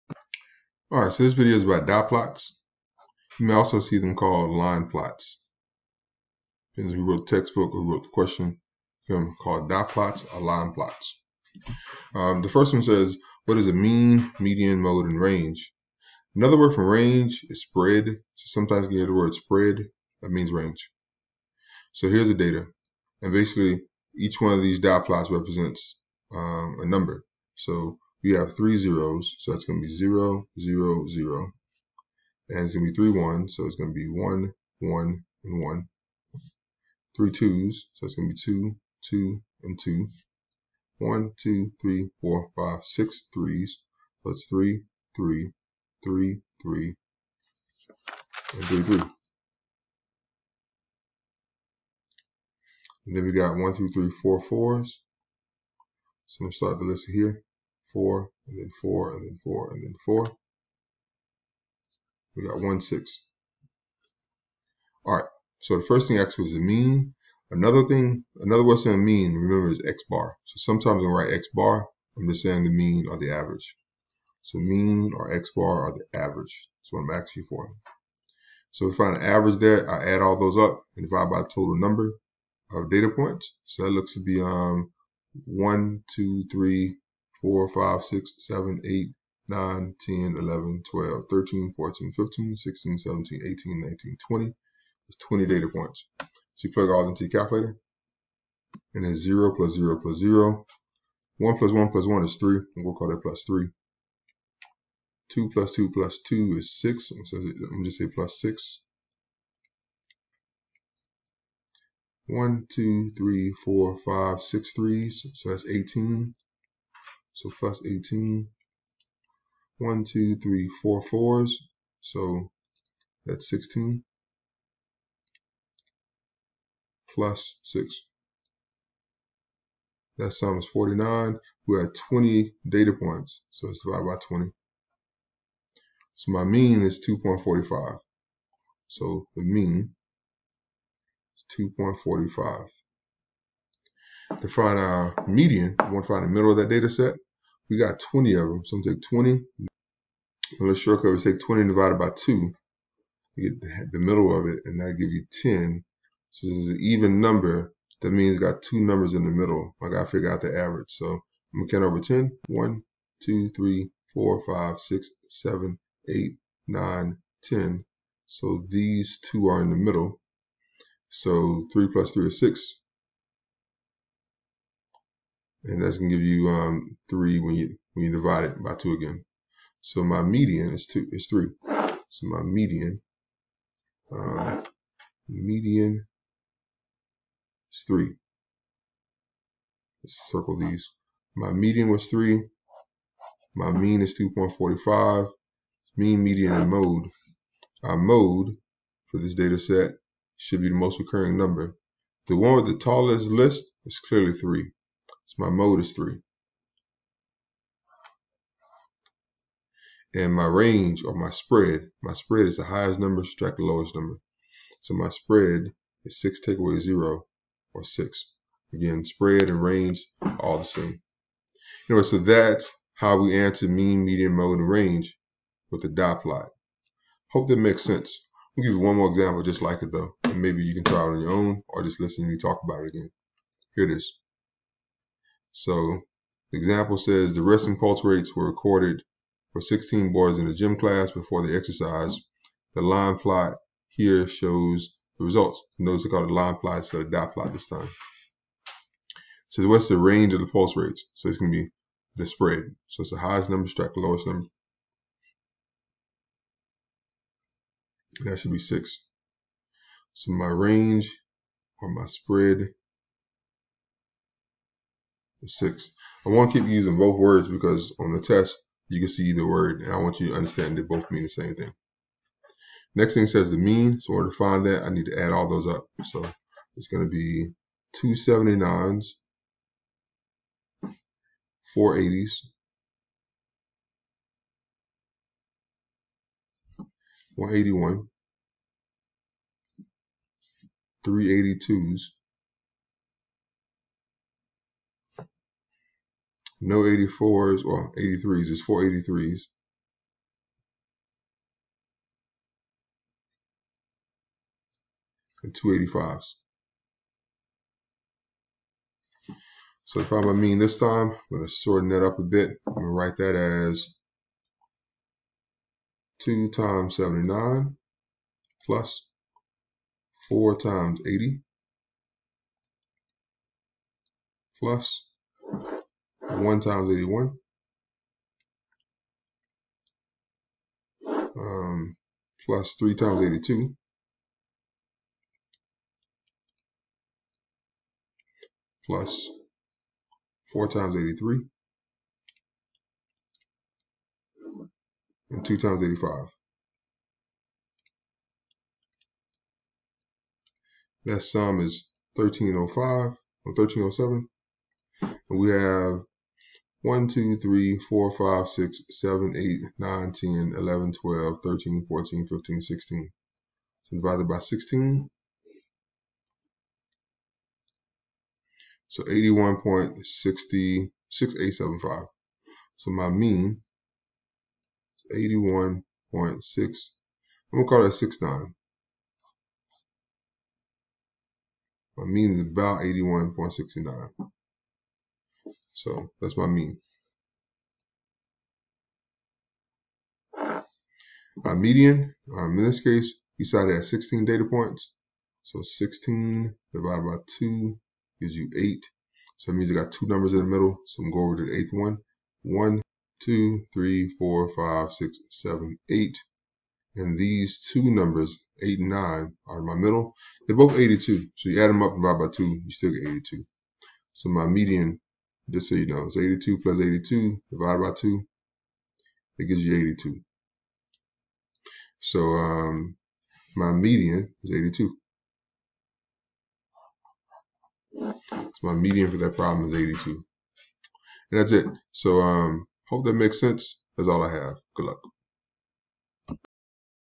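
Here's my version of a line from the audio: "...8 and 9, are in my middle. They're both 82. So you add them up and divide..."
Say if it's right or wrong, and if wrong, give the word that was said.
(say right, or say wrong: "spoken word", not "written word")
right.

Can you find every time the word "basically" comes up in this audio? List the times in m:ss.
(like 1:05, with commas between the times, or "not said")
0:23.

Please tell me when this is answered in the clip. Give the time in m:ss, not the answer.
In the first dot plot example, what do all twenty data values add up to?
2:10.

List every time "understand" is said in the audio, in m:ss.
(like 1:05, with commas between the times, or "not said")
4:30.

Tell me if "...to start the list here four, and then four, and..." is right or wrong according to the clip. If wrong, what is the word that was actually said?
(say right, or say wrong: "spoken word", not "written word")
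right.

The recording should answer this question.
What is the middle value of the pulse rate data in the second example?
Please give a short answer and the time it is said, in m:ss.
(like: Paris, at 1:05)
82, at 7:08.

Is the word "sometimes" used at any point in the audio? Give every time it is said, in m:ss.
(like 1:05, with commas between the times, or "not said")
0:18, 1:10.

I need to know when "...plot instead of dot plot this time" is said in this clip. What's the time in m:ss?
4:06.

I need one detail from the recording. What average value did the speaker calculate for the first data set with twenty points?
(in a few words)
2.45.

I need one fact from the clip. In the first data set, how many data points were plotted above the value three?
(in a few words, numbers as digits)
6.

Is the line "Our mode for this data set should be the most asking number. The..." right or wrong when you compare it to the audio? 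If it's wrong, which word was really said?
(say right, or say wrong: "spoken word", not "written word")
wrong: "recurring", not "asking".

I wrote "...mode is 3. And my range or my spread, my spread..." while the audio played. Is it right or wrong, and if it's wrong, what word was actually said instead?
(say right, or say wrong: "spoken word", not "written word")
right.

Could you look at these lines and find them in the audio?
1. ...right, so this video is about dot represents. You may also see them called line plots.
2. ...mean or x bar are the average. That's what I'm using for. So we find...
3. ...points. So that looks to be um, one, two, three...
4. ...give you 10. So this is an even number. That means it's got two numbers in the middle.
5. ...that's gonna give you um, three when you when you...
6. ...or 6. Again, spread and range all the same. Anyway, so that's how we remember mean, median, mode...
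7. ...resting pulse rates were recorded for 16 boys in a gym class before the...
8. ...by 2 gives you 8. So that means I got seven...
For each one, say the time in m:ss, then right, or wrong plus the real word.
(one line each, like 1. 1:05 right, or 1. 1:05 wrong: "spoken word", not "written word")
1. 0:01 wrong: "plots", not "represents"
2. 1:14 wrong: "asking", not "using"
3. 1:23 right
4. 2:34 right
5. 2:55 right
6. 3:37 wrong: "answer", not "remember"
7. 3:57 right
8. 6:37 wrong: "two", not "seven".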